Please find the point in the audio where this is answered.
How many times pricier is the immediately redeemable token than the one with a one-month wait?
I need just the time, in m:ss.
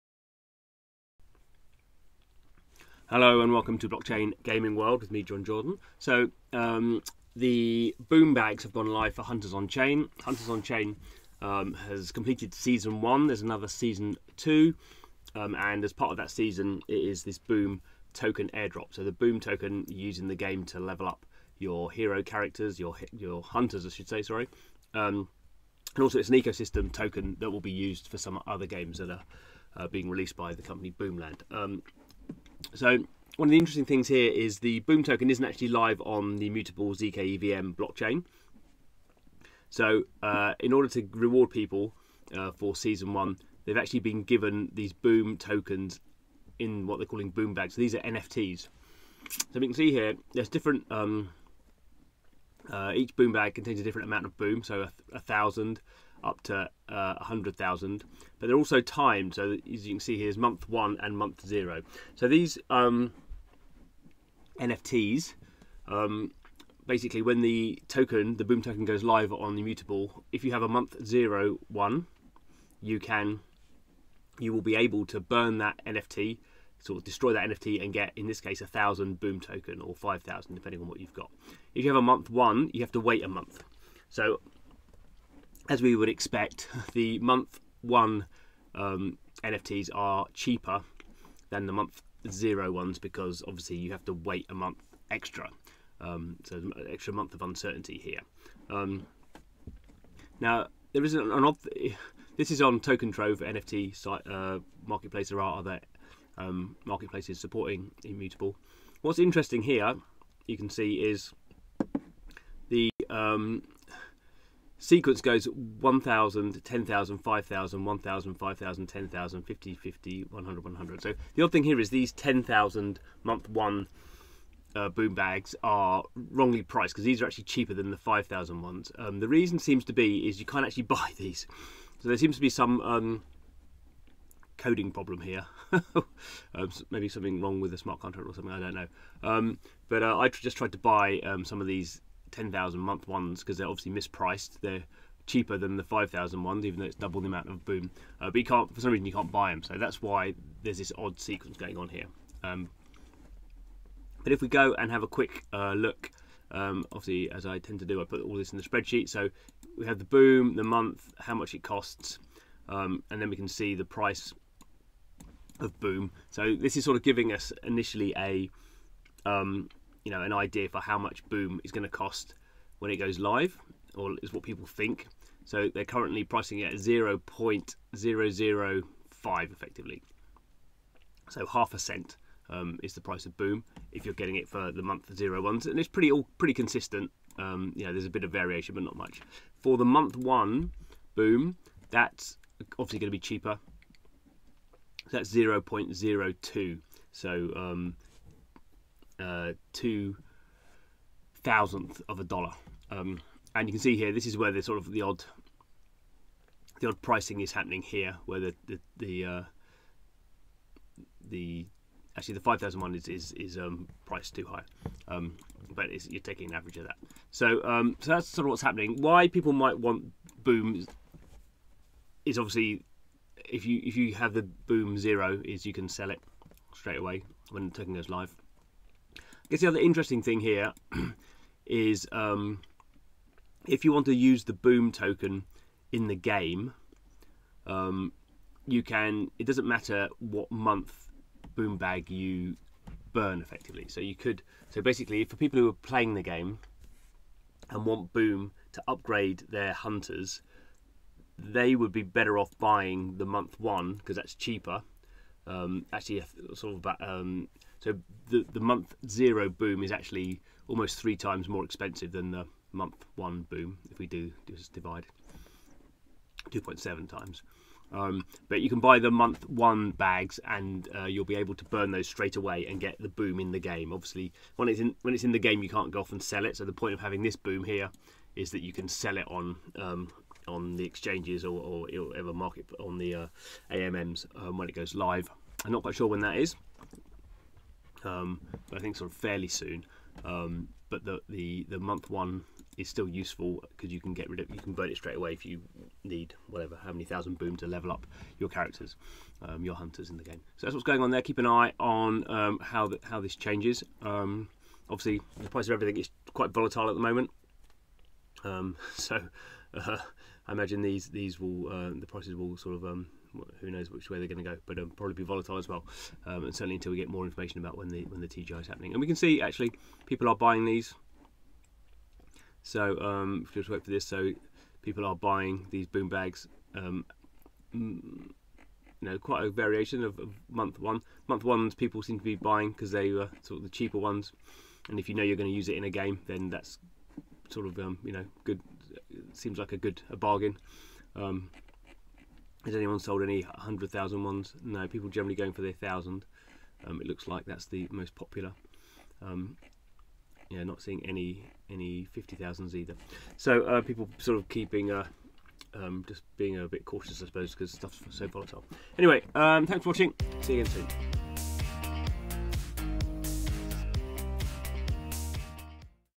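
4:26.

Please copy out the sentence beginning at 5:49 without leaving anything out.
Um, yeah, not seeing any any 50,000s either.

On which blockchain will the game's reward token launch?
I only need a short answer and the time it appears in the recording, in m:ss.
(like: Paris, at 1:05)
Immutable zkEVM, at 0:36.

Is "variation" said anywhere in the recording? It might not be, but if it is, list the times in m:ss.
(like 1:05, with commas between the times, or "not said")
3:08, 5:29.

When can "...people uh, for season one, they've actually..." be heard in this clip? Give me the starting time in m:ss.
0:41.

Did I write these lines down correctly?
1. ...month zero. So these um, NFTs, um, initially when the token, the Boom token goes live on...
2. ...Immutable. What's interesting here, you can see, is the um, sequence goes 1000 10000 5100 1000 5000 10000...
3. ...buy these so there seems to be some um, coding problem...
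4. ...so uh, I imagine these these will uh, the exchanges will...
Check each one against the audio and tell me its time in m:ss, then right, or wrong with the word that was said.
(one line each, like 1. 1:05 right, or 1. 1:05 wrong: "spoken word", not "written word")
1. 1:01 wrong: "basically", not "initially"
2. 1:48 wrong: "5000", not "5100"
3. 2:10 right
4. 5:08 wrong: "prices", not "exchanges".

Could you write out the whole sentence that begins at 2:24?
They're cheaper than the 5,000 ones, even though it's double the amount of boom.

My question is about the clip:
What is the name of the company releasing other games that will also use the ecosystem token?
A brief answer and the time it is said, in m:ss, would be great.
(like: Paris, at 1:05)
Boomland, at 0:30.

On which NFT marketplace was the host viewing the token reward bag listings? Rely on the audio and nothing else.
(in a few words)
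Token Trove.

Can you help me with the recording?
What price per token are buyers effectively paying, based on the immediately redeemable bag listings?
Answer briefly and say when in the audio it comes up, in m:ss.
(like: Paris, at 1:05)
0.005, at 2:56.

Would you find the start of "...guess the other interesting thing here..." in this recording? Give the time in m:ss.
3:49.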